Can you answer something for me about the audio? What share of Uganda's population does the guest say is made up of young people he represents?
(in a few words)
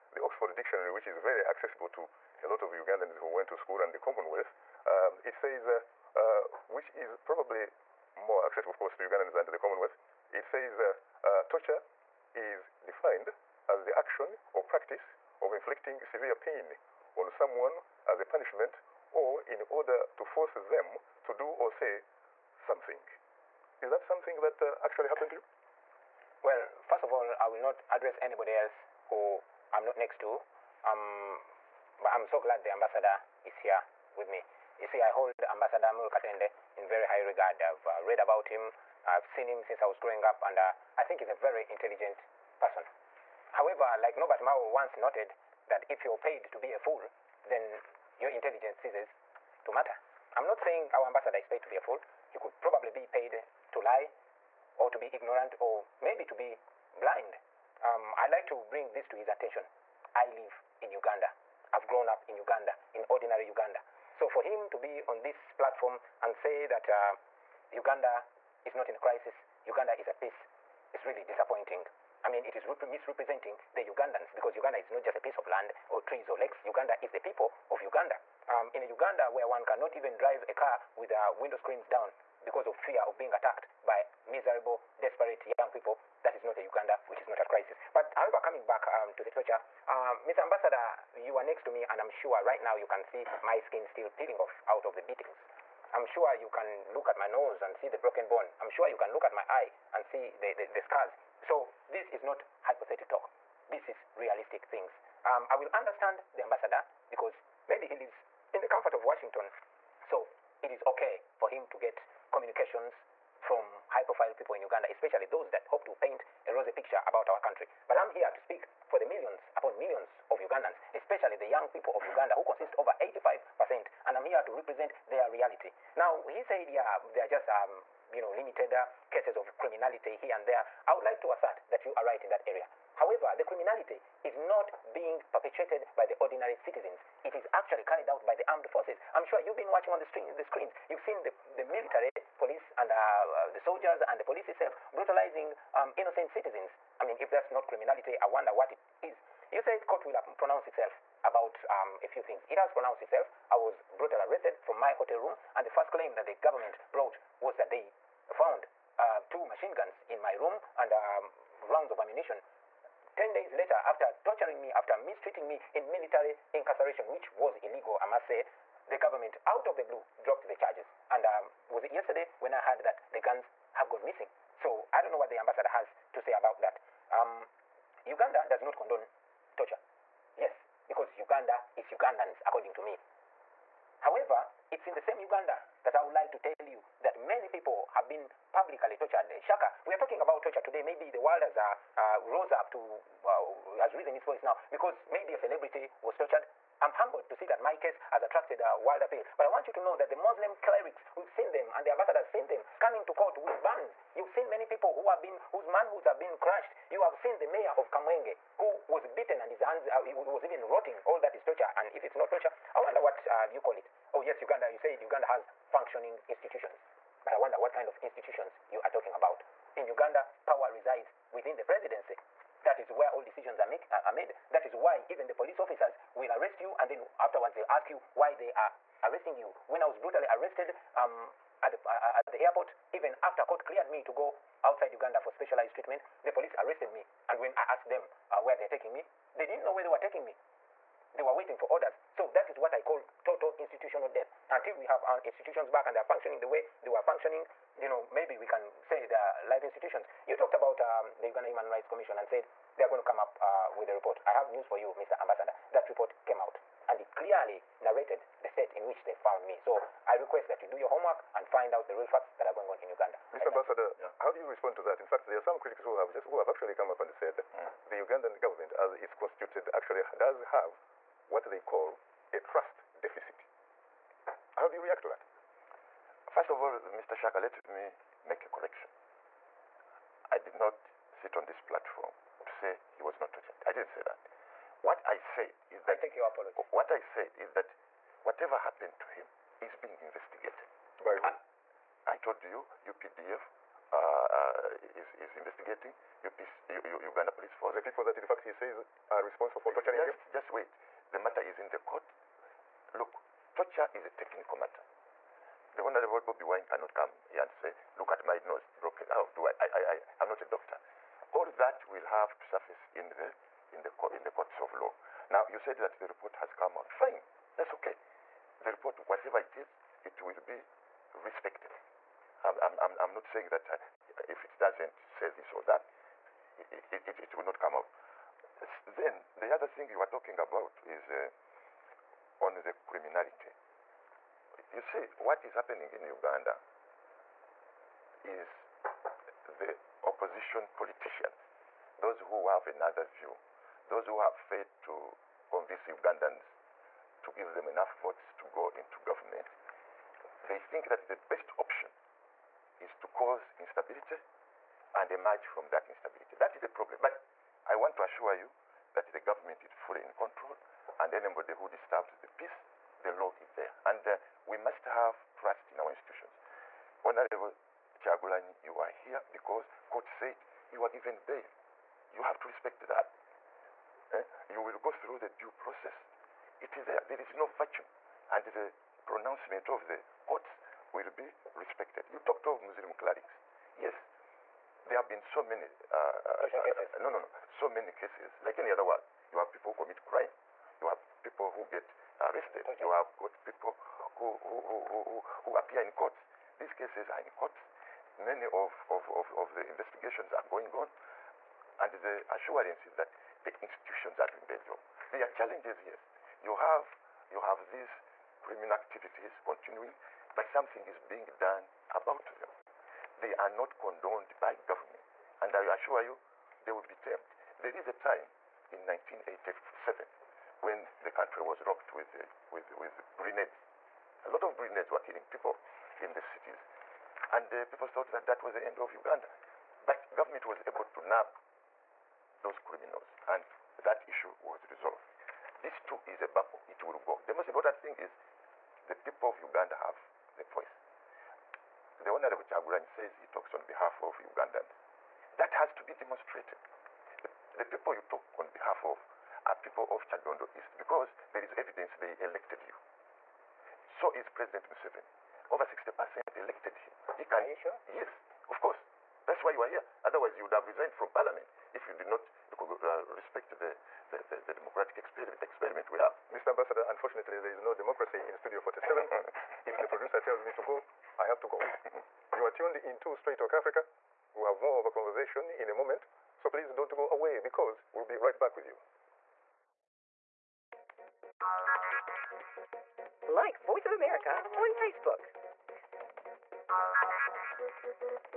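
85%.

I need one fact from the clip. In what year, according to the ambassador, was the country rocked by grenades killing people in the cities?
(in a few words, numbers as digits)
1987.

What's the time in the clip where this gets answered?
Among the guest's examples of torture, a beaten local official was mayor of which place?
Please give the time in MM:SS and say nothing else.
03:27.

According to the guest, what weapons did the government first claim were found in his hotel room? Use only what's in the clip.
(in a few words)
two machine guns.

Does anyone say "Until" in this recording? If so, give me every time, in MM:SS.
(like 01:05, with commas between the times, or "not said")
04:04.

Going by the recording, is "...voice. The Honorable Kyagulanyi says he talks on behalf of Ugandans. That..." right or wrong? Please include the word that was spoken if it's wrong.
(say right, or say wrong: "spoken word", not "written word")
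right.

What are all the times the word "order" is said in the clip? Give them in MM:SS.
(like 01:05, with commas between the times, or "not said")
00:19, 04:01.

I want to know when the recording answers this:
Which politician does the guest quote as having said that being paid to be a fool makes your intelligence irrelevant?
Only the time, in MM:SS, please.
00:44.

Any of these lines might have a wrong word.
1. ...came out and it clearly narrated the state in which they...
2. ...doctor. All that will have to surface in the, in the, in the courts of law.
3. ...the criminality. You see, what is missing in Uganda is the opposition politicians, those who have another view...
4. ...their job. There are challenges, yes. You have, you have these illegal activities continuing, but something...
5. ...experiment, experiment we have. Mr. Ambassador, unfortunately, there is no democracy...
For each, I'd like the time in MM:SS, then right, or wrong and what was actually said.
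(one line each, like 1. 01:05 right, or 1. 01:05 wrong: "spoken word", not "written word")
1. 04:16 right
2. 05:10 right
3. 05:32 wrong: "happening", not "missing"
4. 06:44 wrong: "criminal", not "illegal"
5. 07:44 right.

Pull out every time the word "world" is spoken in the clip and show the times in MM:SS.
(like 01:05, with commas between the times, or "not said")
03:11, 03:18, 06:28.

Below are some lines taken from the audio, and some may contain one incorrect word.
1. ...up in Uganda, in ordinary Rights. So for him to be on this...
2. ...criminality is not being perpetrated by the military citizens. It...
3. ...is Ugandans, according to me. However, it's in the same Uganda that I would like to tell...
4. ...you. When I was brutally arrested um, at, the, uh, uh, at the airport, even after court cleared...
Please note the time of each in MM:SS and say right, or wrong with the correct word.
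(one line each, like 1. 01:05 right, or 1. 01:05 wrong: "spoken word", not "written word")
1. 01:02 wrong: "Uganda", not "Rights"
2. 02:13 wrong: "ordinary", not "military"
3. 03:01 right
4. 03:49 right.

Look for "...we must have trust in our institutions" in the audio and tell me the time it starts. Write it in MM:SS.
06:04.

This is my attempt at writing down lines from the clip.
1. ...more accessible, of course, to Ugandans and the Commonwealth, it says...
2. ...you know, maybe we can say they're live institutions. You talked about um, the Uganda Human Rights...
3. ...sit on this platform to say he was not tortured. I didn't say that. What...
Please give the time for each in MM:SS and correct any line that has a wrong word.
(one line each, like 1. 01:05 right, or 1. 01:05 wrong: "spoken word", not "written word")
1. 00:08 right
2. 04:07 right
3. 04:41 right.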